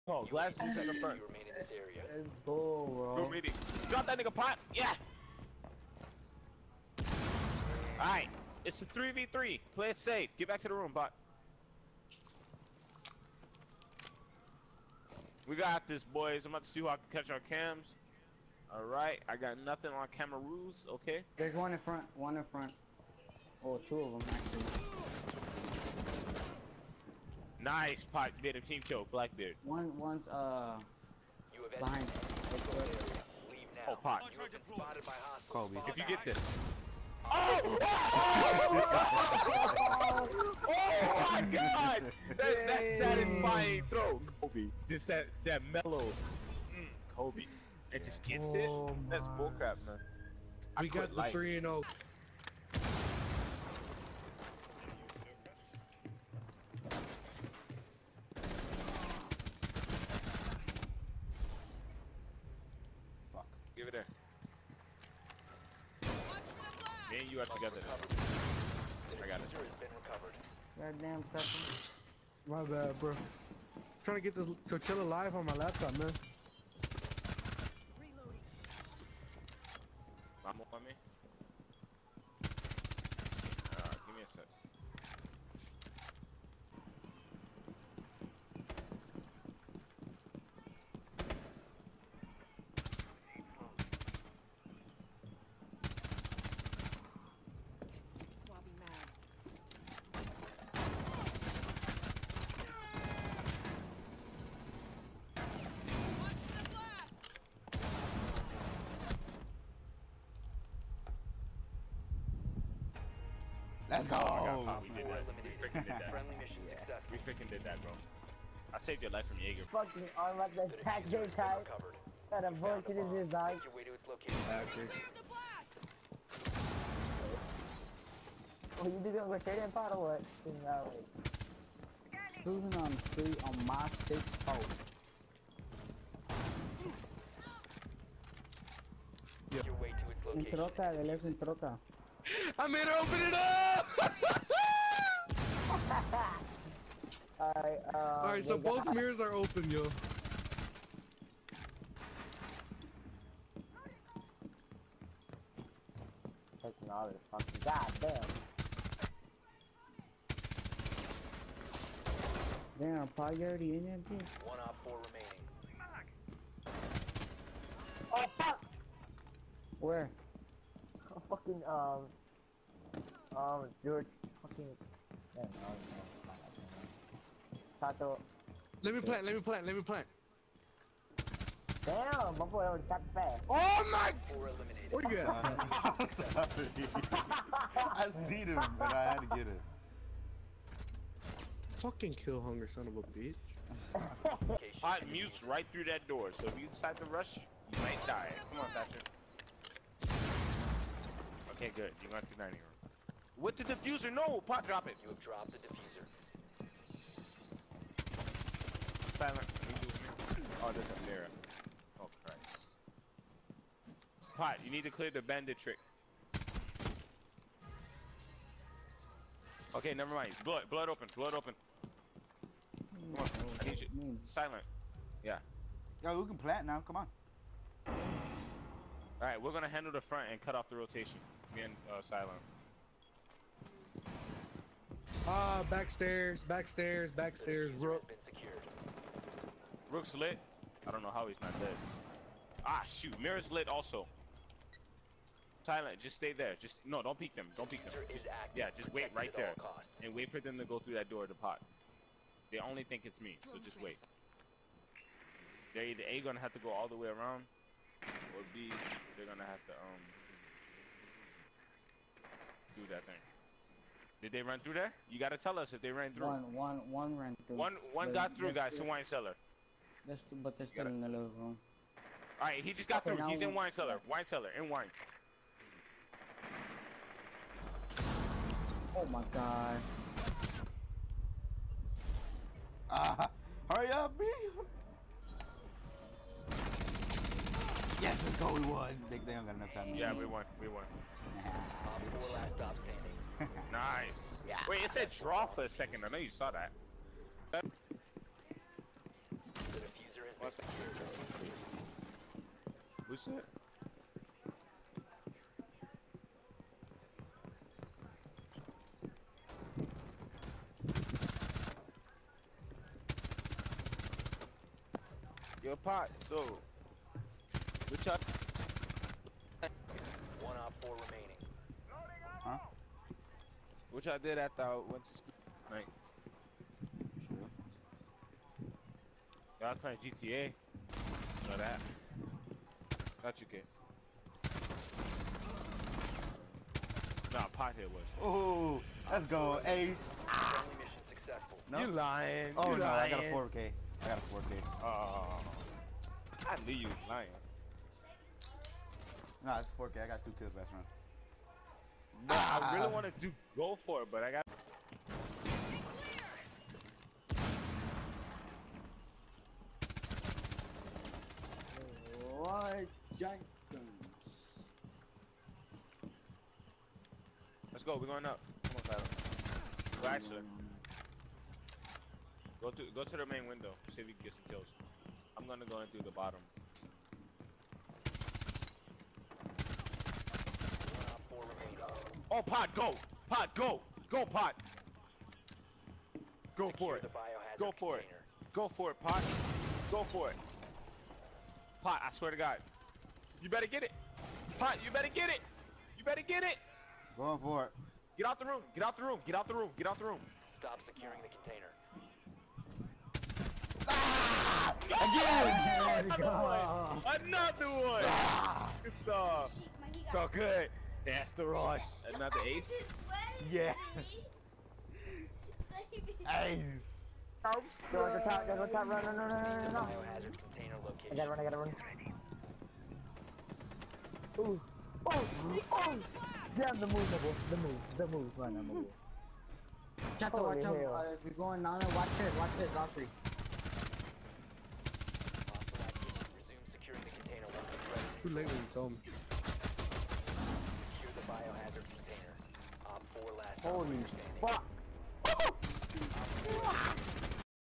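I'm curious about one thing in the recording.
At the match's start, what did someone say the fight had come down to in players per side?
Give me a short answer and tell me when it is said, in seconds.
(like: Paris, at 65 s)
3v3, at 8 s.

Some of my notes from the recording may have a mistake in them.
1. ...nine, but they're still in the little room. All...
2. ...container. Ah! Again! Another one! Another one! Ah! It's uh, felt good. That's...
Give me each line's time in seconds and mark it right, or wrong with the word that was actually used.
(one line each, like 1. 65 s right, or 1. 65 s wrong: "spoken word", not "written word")
1. 270 s wrong: "two", not "nine"
2. 403 s right.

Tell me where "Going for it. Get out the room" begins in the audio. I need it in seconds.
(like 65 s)
397 s.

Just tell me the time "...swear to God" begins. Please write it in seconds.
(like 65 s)
392 s.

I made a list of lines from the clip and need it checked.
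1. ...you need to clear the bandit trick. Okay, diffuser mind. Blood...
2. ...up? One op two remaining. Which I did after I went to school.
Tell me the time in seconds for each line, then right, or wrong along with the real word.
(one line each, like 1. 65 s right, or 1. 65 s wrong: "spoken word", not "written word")
1. 214 s wrong: "never", not "diffuser"
2. 318 s wrong: "four", not "two".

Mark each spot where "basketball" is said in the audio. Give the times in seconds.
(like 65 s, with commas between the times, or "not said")
not said.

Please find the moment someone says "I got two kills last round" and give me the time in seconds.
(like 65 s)
350 s.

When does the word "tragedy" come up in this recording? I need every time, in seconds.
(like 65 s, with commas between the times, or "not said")
not said.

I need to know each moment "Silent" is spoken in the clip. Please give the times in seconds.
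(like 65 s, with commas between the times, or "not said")
209 s, 224 s, 232 s, 245 s.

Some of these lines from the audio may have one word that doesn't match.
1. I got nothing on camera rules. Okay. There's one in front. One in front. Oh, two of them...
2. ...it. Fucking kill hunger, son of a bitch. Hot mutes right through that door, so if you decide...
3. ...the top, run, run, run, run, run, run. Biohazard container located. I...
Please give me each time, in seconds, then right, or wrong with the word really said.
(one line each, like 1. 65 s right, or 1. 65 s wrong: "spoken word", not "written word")
1. 19 s right
2. 189 s right
3. 418 s right.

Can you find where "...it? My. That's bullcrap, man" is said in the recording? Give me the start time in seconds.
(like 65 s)
48 s.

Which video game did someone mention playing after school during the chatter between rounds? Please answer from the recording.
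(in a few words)
GTA.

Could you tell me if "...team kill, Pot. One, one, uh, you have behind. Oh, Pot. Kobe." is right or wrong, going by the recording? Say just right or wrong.
wrong.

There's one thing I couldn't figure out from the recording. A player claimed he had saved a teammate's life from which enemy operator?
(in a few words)
Jaeger.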